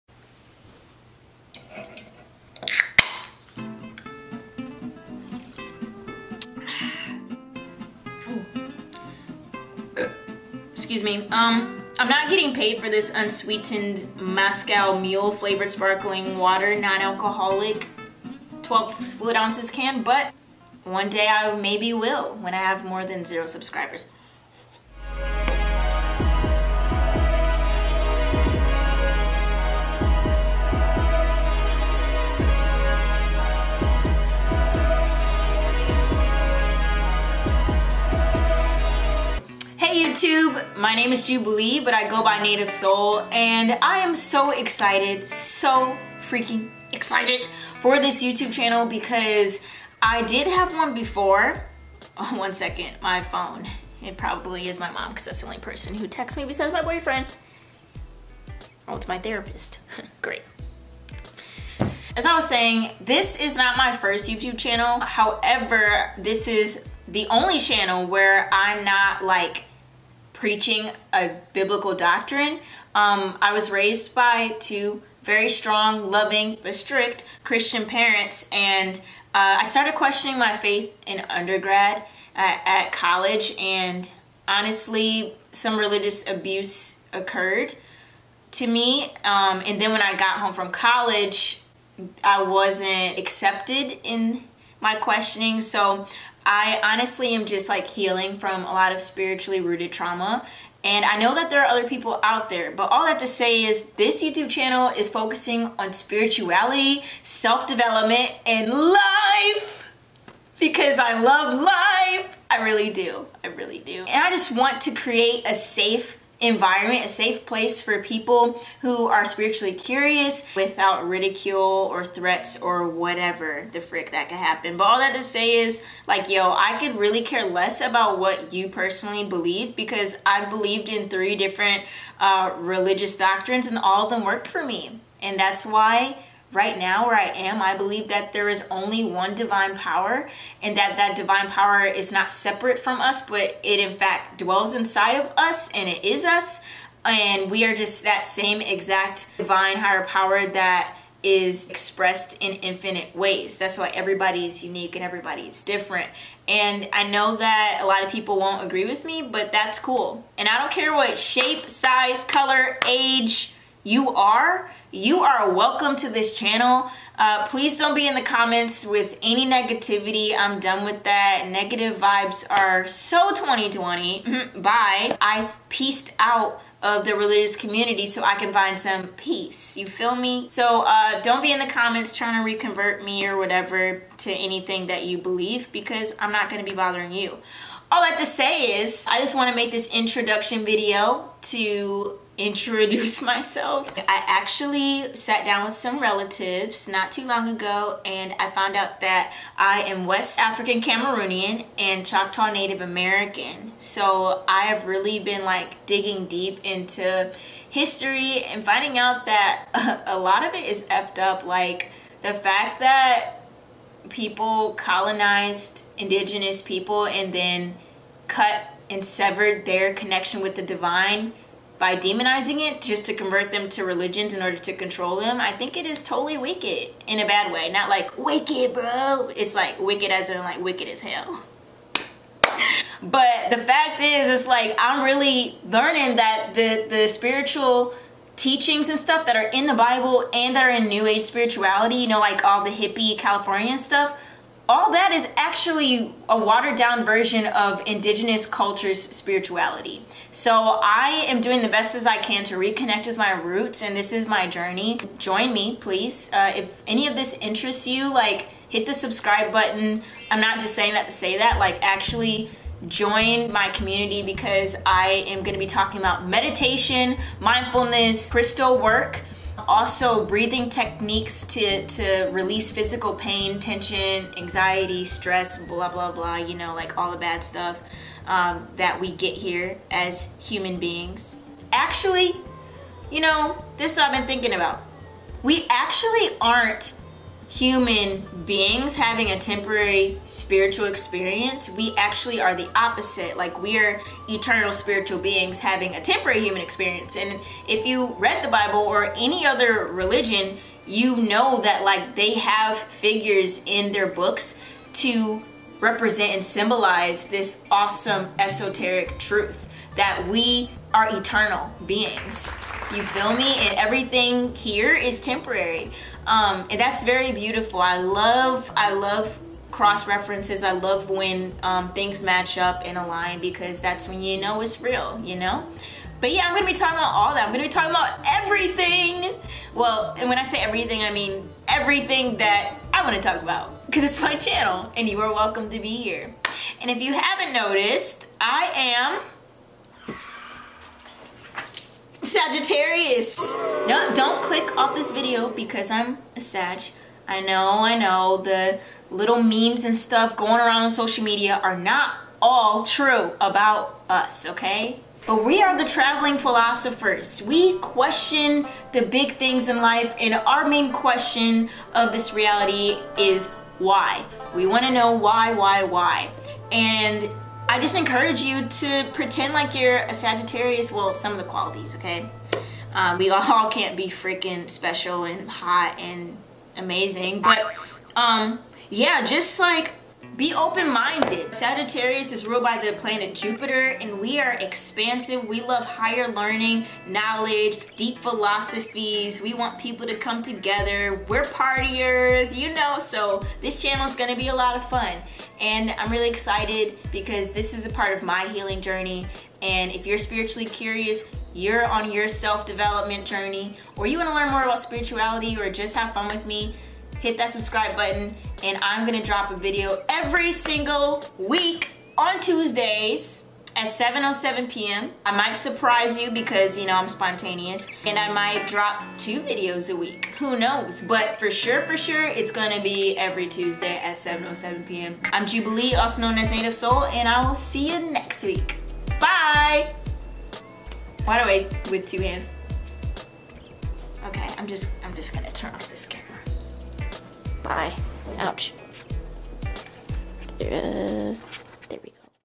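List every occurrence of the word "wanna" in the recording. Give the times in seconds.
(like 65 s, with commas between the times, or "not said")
333 s, 404 s.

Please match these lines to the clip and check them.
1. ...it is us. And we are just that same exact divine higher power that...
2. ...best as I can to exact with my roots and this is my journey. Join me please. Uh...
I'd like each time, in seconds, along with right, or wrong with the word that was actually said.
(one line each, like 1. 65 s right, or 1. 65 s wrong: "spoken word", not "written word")
1. 145 s right
2. 251 s wrong: "reconnect", not "exact".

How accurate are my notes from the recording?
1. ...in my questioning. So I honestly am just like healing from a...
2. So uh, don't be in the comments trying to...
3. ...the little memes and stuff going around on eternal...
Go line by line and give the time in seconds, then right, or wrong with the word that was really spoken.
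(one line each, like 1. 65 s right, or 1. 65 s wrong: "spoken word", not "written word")
1. 94 s right
2. 180 s right
3. 348 s wrong: "social", not "eternal".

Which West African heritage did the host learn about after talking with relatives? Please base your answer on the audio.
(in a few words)
Cameroonian.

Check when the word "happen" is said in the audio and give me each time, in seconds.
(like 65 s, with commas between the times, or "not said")
124 s.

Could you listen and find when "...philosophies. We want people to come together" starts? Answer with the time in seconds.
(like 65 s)
388 s.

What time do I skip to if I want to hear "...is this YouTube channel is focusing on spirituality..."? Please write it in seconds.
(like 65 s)
103 s.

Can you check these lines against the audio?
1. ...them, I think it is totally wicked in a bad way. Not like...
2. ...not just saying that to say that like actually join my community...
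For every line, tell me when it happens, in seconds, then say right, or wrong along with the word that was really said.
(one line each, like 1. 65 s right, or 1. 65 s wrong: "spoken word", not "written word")
1. 225 s right
2. 260 s right.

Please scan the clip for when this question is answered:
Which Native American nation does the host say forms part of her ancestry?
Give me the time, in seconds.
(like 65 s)
202 s.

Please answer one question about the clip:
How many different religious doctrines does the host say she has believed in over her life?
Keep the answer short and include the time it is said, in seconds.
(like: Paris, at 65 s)
3, at 131 s.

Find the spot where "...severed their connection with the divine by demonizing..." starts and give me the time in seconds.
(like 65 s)
219 s.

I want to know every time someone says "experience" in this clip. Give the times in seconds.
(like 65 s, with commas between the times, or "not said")
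290 s, 296 s.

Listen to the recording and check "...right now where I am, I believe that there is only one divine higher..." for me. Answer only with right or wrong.
wrong.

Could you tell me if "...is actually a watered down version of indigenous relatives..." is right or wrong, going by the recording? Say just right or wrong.
wrong.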